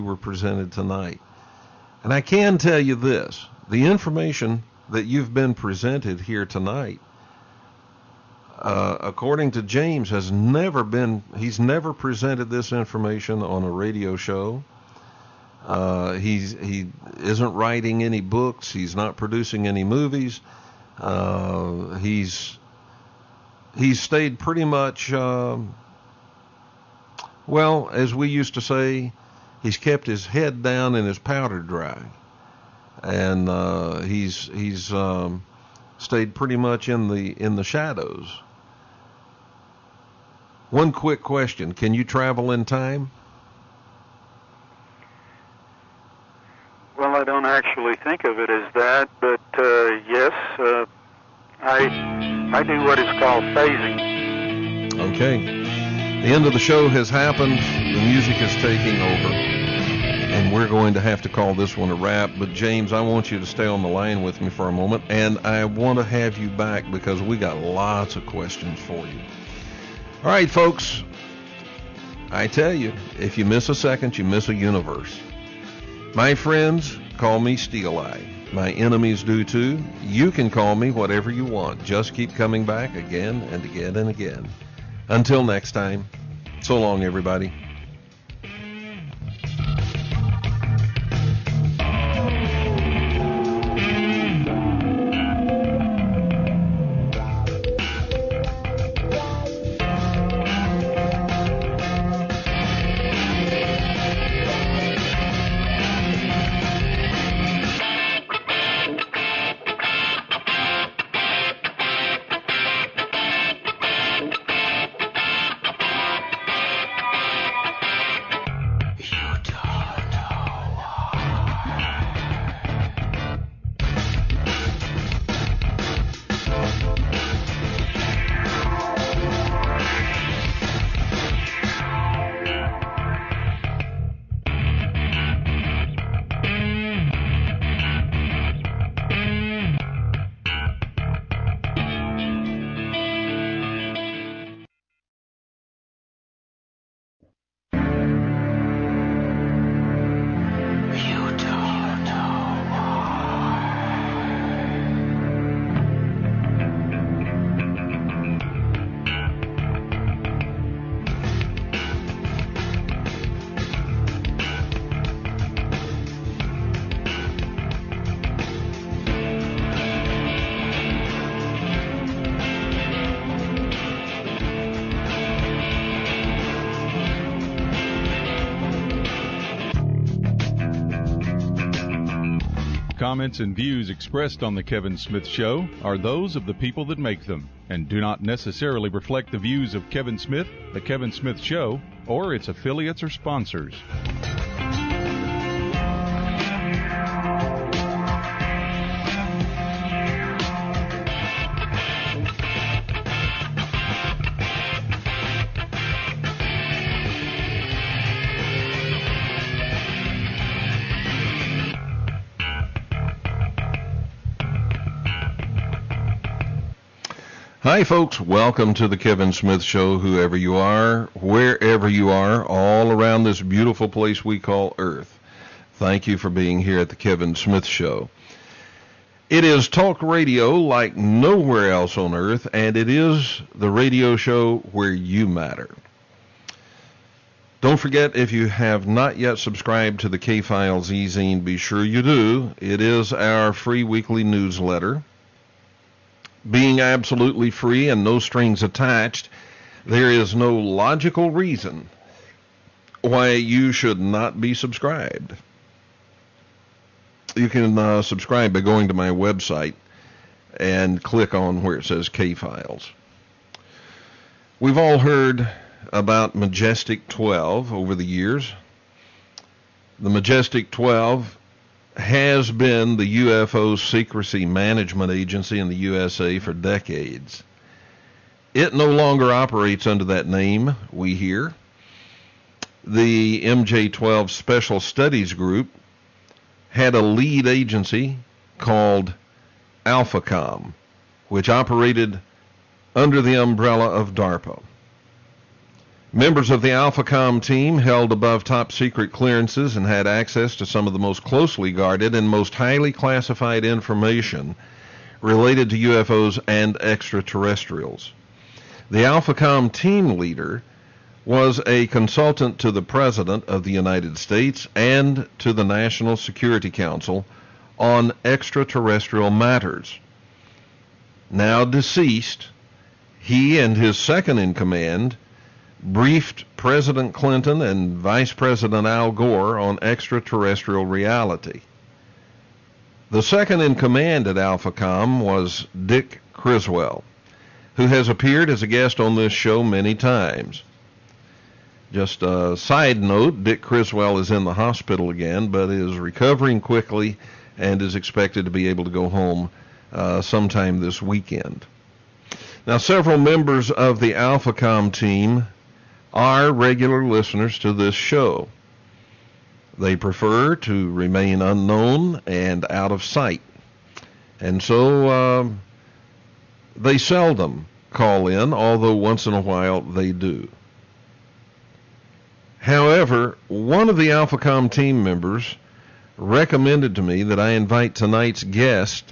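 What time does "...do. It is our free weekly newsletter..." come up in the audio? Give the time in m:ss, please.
4:02.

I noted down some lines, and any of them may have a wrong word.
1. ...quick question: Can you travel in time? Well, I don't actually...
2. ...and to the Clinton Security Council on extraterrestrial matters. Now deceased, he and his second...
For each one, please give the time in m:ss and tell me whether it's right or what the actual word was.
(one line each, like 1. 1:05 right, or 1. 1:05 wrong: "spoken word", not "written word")
1. 0:40 right
2. 5:14 wrong: "National", not "Clinton".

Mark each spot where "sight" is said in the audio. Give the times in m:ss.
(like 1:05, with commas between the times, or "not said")
6:03.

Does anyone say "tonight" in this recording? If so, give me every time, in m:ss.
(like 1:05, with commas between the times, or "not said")
0:00, 0:06, 6:17.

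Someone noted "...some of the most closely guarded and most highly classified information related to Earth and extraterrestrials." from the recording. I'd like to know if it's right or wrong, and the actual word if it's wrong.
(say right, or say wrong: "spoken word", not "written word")
wrong: "UFOs", not "Earth".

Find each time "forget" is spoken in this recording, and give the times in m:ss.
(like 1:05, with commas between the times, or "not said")
3:57.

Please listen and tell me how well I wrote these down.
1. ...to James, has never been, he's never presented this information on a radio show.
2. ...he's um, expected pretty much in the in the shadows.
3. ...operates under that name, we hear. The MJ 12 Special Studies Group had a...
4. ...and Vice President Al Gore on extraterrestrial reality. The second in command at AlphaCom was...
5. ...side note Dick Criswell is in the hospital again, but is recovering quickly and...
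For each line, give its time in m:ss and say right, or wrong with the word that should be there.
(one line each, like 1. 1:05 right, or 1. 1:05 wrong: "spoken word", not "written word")
1. 0:09 right
2. 0:34 wrong: "stayed", not "expected"
3. 4:39 right
4. 5:27 right
5. 5:42 right.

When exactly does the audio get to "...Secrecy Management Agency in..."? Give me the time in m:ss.
4:33.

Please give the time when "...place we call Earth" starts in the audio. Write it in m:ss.
3:43.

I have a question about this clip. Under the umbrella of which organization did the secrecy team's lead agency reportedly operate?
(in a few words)
DARPA.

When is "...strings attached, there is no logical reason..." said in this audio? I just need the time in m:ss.
4:08.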